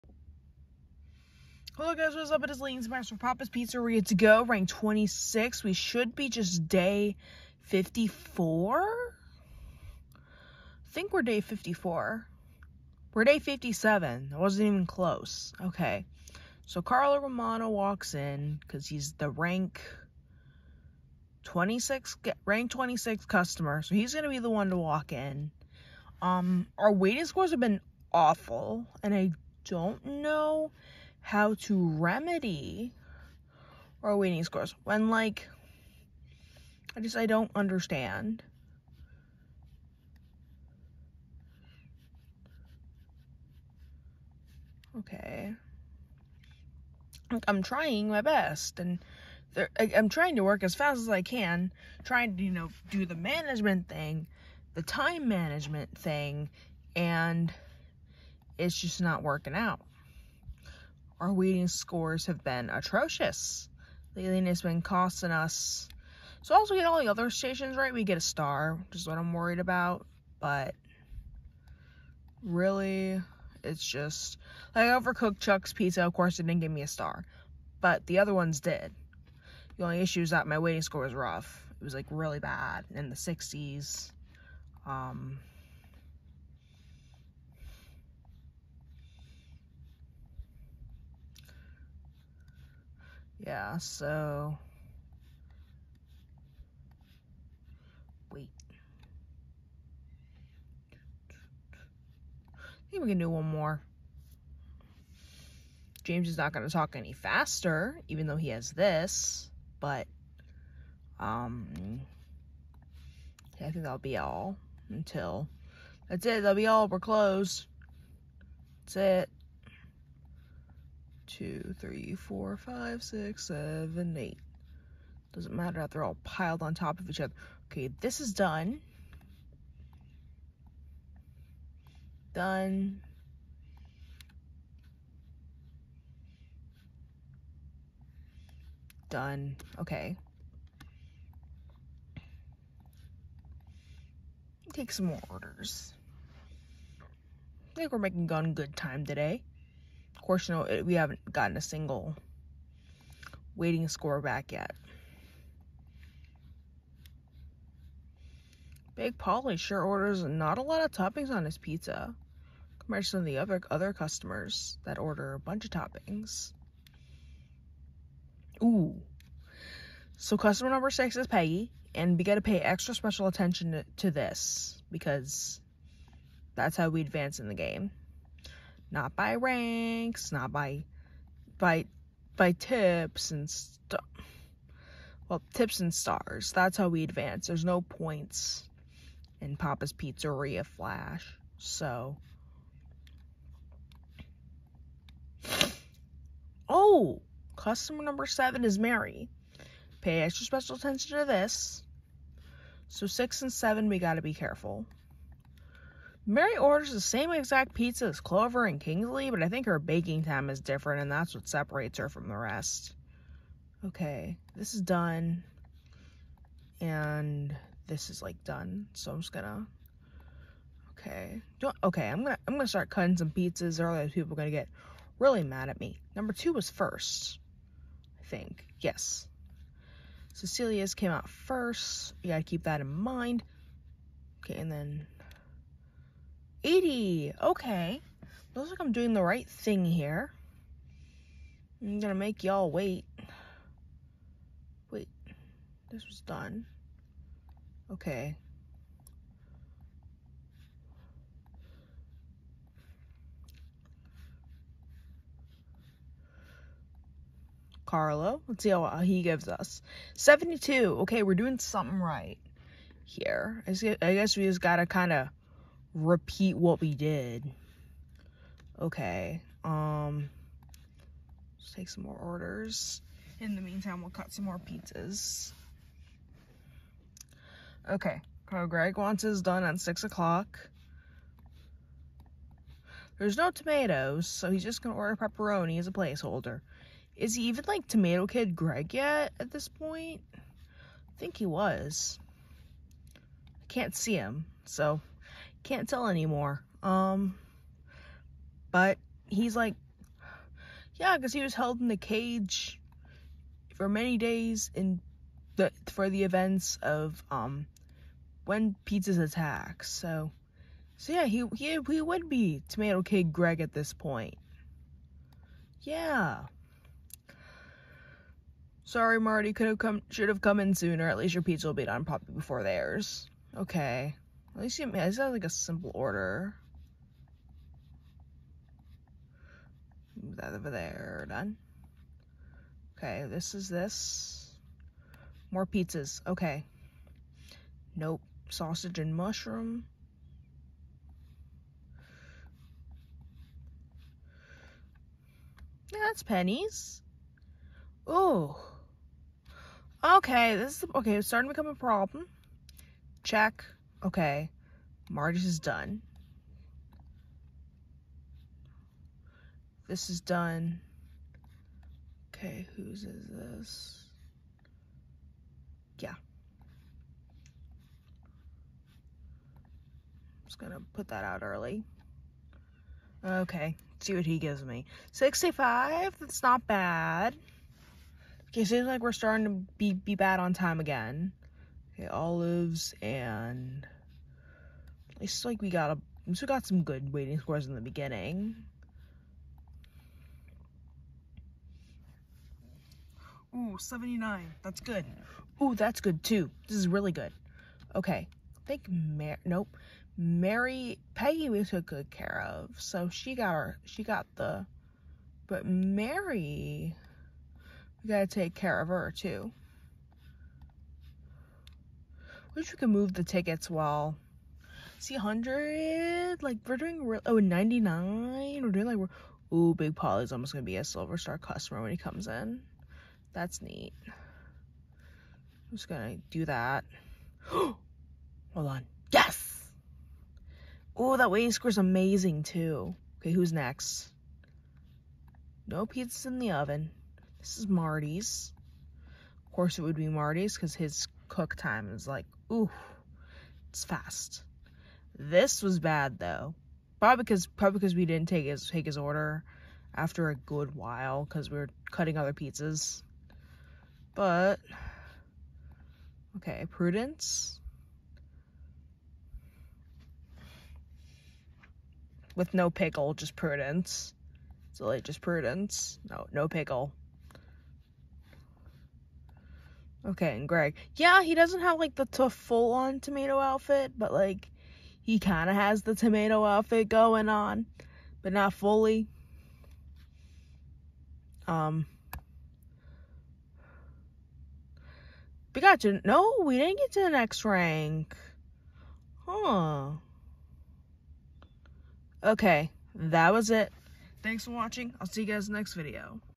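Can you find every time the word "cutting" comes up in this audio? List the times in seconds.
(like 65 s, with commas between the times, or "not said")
222 s, 451 s.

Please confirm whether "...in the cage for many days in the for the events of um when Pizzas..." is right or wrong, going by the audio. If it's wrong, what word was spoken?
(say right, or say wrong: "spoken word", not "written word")
right.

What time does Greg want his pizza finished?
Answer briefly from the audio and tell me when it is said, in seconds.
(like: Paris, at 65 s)
6 o'clock, at 279 s.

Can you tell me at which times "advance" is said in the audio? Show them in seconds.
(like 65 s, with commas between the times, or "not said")
177 s, 187 s.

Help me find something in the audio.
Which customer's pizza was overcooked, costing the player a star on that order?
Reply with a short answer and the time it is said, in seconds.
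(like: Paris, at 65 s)
Chuck, at 75 s.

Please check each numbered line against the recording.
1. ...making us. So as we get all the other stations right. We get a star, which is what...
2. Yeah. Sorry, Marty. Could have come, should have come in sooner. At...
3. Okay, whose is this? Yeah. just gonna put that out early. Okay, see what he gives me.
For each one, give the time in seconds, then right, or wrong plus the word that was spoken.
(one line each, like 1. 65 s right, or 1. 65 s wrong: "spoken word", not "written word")
1. 64 s wrong: "costing", not "making"
2. 315 s right
3. 362 s right.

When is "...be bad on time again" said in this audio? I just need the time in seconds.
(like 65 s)
379 s.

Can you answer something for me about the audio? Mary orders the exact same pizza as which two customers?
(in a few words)
Clover and Kingsley.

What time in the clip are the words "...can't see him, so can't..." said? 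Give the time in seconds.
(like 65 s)
293 s.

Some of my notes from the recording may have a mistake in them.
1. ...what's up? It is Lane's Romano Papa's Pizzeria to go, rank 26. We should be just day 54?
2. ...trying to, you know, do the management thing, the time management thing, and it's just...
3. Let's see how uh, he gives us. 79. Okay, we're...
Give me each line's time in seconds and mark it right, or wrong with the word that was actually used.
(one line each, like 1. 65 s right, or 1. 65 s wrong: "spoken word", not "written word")
1. 2 s wrong: "Master", not "Romano"
2. 52 s right
3. 258 s wrong: "72", not "79".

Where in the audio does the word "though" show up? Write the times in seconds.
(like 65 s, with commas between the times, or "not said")
108 s, 446 s.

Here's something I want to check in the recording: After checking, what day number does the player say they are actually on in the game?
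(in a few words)
57.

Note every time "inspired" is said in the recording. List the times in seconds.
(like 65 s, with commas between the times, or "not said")
not said.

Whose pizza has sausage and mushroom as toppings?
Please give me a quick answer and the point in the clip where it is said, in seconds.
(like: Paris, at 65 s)
Penny, at 346 s.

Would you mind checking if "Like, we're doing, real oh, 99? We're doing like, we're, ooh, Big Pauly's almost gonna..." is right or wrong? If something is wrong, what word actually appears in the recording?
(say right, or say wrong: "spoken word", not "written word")
right.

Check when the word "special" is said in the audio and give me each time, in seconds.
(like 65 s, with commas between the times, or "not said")
172 s, 200 s.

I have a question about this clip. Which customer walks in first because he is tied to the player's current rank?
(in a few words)
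Carlo Romano.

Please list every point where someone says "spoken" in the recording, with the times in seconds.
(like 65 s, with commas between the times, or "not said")
not said.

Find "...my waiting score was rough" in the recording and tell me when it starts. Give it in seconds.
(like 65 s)
80 s.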